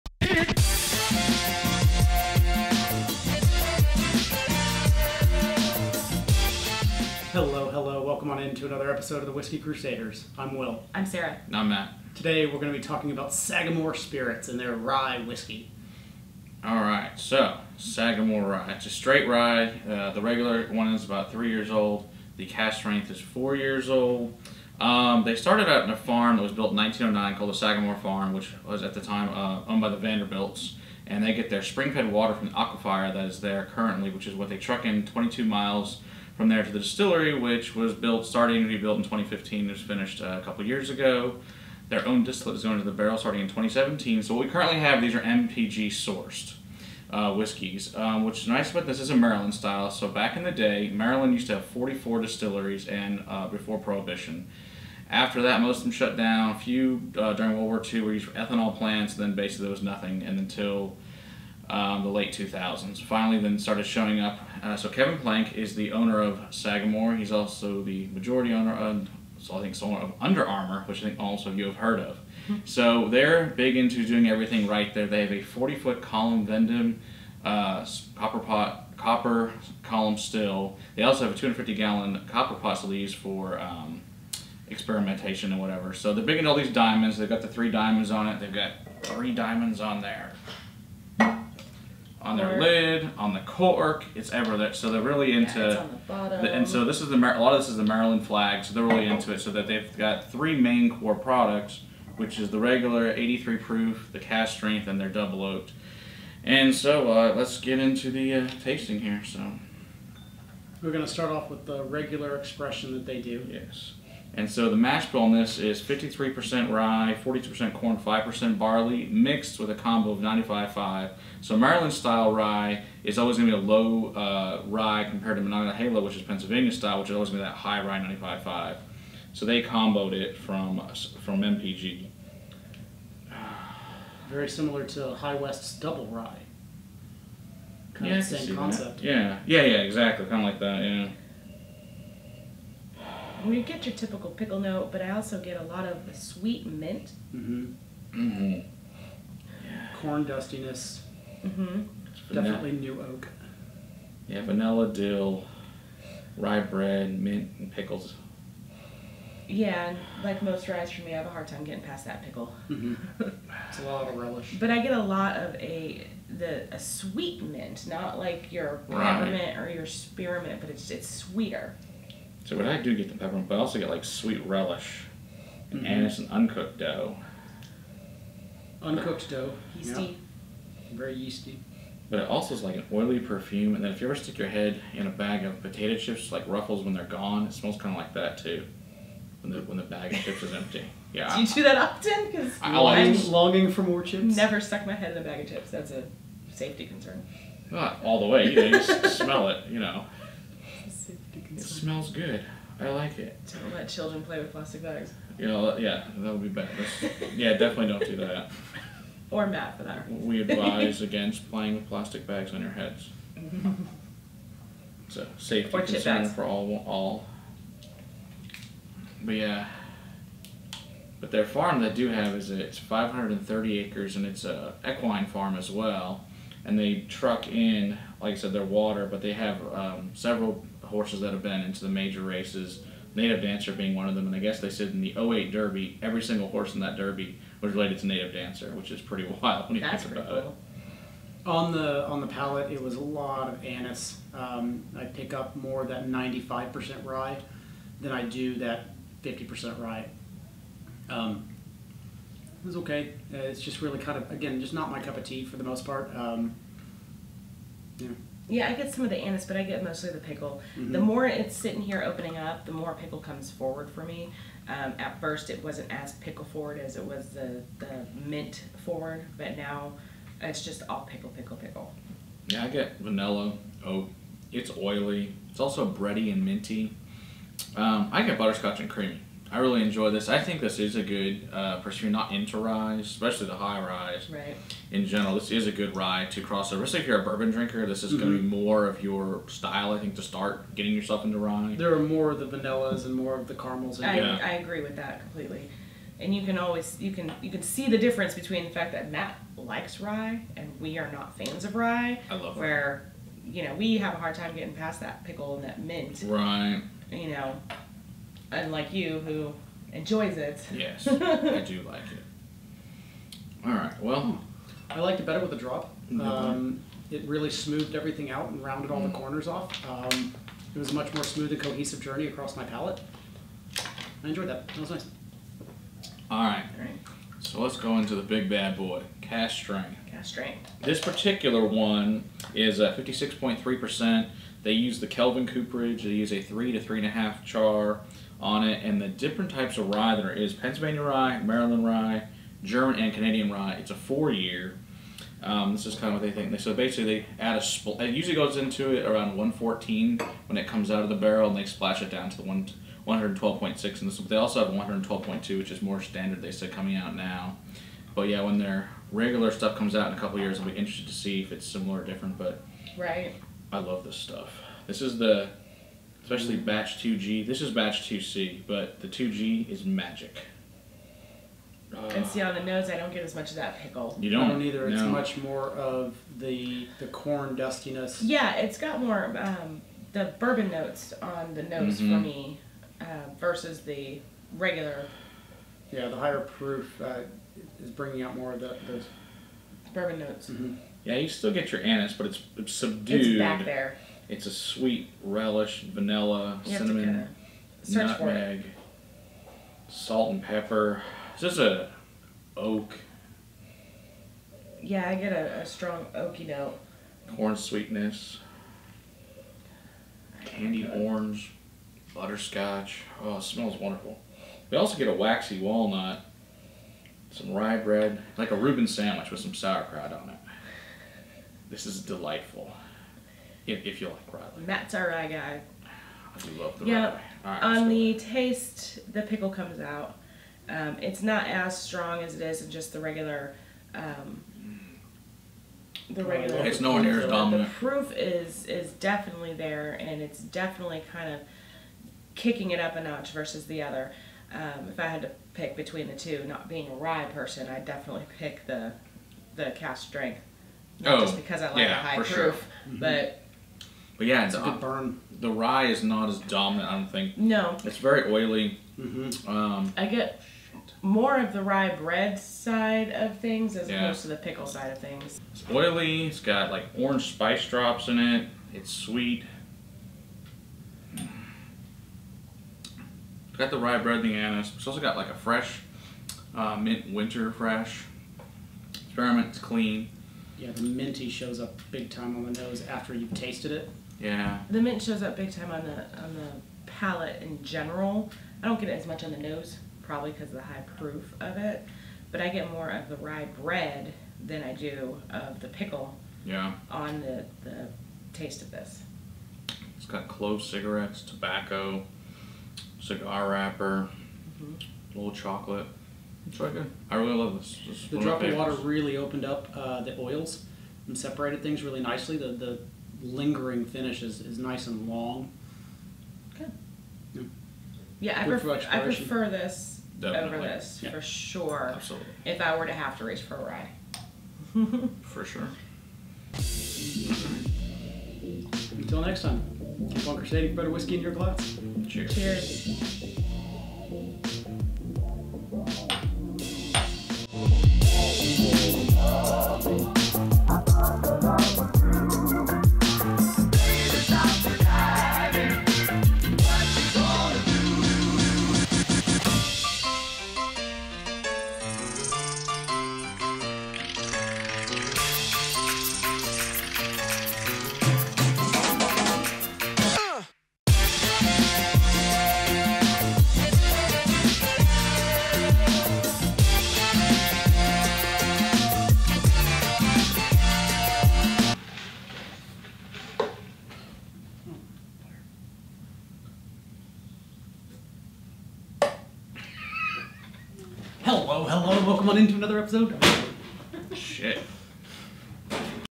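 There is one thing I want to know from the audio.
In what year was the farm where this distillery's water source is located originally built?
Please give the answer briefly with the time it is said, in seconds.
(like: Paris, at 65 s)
1909, at 26 s.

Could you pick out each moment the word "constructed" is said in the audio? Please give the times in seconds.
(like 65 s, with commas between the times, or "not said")
not said.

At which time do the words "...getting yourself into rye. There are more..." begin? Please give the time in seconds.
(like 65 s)
290 s.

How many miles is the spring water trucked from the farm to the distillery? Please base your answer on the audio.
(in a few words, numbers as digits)
22.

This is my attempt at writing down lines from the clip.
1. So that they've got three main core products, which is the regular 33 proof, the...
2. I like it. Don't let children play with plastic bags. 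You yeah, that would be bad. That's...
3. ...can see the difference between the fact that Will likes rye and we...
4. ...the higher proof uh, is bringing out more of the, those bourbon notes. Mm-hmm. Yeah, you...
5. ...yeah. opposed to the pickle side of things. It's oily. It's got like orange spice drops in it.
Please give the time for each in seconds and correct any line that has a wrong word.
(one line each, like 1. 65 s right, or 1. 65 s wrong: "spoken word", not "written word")
1. 99 s wrong: "83", not "33"
2. 202 s right
3. 297 s wrong: "Matt", not "Will"
4. 386 s right
5. 463 s right.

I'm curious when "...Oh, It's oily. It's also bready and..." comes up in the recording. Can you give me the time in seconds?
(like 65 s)
273 s.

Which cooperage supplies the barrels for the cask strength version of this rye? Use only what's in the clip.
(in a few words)
Kelvin Cooperage.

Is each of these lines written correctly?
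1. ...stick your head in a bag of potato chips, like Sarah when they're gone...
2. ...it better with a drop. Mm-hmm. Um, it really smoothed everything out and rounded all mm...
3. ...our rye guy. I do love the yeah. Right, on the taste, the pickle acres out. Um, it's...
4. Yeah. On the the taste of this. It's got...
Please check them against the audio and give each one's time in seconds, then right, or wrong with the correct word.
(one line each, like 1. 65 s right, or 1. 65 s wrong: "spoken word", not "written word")
1. 184 s wrong: "Ruffles", not "Sarah"
2. 315 s right
3. 424 s wrong: "comes", not "acres"
4. 496 s right.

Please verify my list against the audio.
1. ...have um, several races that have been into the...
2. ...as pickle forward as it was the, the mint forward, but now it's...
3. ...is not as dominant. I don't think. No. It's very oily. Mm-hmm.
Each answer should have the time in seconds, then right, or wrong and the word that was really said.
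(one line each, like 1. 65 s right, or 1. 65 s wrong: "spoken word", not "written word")
1. 229 s wrong: "horses", not "races"
2. 265 s right
3. 455 s right.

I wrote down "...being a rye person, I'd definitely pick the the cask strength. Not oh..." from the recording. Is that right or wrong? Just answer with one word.
right.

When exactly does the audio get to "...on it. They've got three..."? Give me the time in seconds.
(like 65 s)
88 s.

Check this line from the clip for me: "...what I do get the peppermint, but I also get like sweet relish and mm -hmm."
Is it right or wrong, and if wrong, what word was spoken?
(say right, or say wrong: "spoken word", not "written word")
right.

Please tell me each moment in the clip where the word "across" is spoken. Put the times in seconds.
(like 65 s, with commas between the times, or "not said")
322 s.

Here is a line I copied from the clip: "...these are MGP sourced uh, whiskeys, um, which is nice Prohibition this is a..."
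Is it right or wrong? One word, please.
wrong.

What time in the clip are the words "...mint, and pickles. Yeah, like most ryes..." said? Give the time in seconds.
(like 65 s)
157 s.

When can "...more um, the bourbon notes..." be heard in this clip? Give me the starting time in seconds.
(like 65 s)
379 s.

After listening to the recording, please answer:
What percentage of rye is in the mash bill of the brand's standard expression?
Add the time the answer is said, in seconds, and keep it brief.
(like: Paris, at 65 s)
53%, at 115 s.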